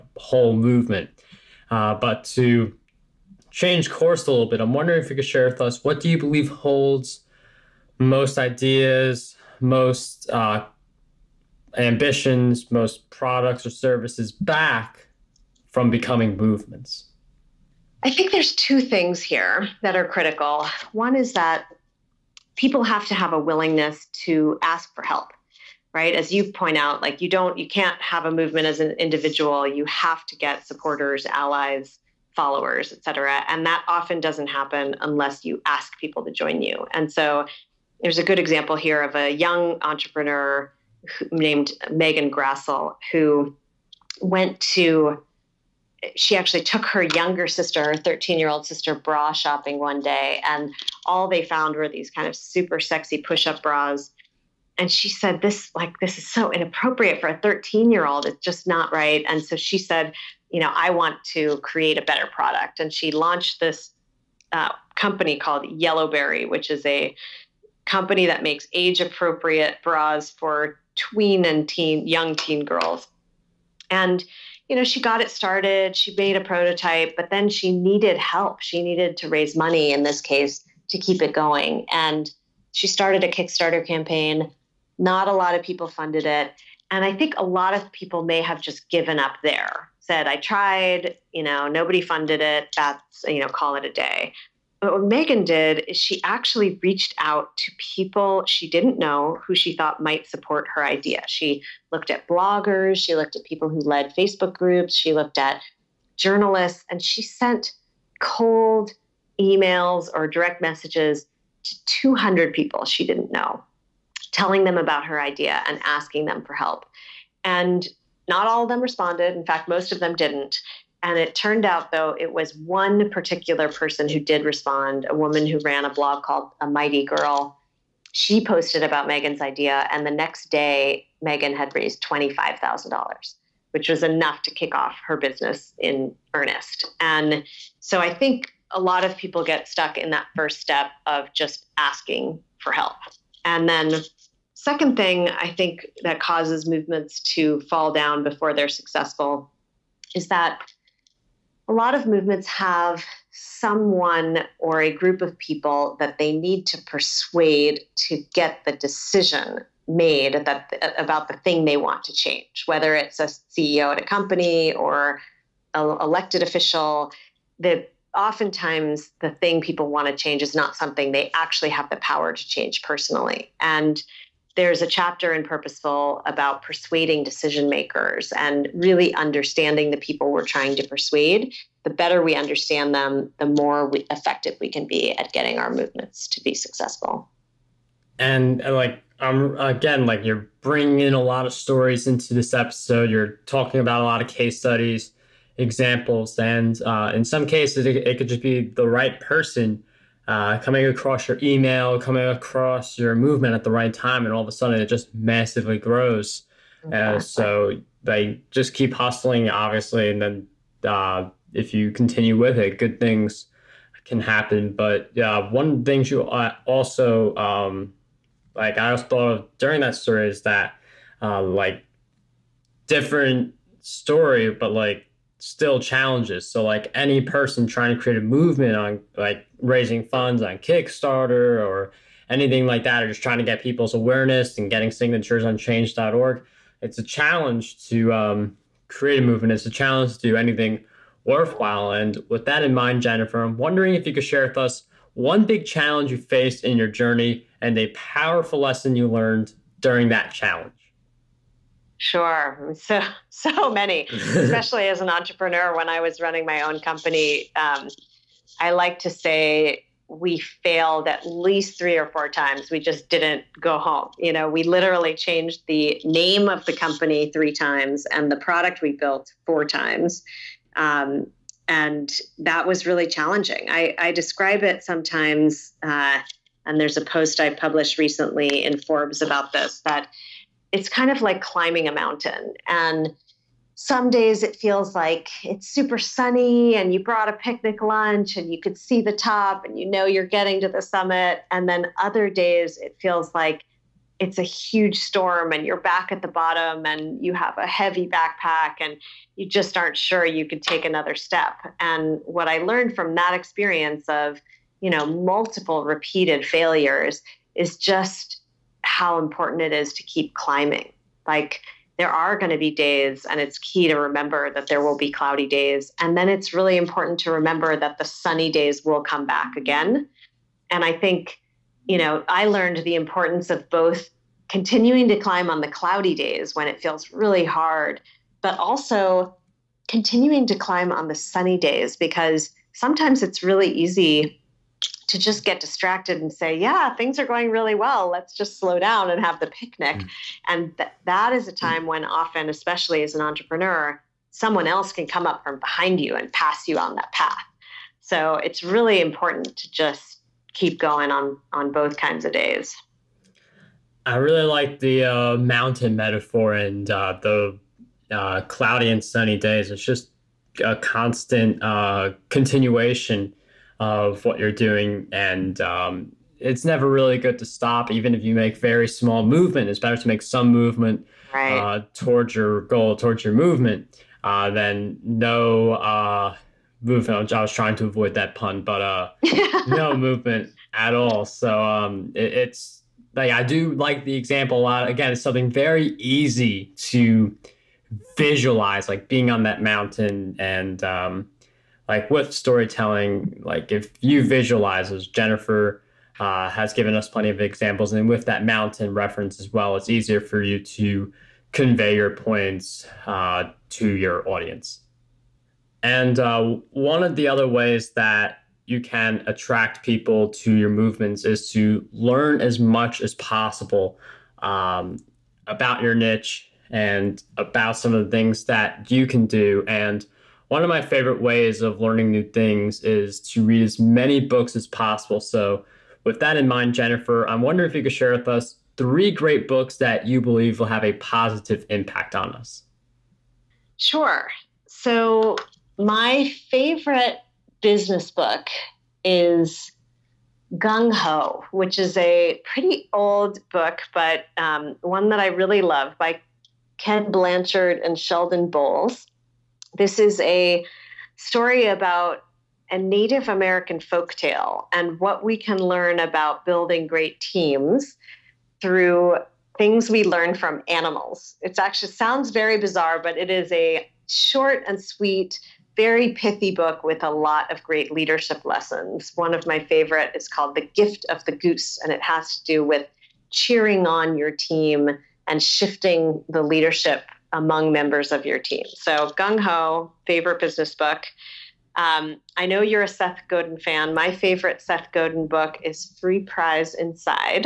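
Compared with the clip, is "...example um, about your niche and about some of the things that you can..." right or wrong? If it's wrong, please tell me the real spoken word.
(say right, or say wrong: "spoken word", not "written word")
wrong: "possible", not "example".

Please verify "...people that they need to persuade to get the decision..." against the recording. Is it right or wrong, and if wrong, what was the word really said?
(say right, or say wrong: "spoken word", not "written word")
right.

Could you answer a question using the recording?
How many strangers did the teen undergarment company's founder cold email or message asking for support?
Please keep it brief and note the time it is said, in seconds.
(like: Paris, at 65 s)
200, at 111 s.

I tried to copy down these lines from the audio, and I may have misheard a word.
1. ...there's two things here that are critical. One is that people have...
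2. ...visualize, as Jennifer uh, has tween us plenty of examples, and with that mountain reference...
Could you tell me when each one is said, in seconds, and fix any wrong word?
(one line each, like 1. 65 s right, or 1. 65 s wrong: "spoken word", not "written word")
1. 18 s right
2. 394 s wrong: "given", not "tween".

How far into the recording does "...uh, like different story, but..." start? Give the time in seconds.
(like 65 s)
221 s.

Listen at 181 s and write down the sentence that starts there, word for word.
The better we understand them, the more we, effective we can be at getting our movements to be successful.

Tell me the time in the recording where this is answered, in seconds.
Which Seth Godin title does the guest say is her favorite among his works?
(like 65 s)
485 s.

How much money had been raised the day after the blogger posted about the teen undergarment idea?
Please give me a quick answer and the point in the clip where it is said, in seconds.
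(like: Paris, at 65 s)
$25,000, at 132 s.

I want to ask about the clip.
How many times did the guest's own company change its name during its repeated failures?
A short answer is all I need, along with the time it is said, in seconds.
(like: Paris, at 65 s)
3, at 267 s.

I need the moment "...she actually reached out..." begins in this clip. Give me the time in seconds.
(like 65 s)
95 s.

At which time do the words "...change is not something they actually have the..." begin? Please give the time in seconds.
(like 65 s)
170 s.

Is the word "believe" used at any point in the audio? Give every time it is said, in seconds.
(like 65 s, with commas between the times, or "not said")
6 s, 430 s.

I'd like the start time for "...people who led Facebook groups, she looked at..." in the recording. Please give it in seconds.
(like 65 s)
103 s.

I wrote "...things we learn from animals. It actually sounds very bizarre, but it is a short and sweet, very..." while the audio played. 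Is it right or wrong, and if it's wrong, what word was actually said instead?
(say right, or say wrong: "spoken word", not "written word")
right.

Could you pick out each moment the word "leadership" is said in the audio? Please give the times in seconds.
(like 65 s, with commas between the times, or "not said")
467 s, 476 s.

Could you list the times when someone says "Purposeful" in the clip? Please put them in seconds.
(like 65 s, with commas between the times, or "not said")
175 s.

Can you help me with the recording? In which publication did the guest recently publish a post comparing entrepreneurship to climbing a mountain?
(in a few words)
Forbes.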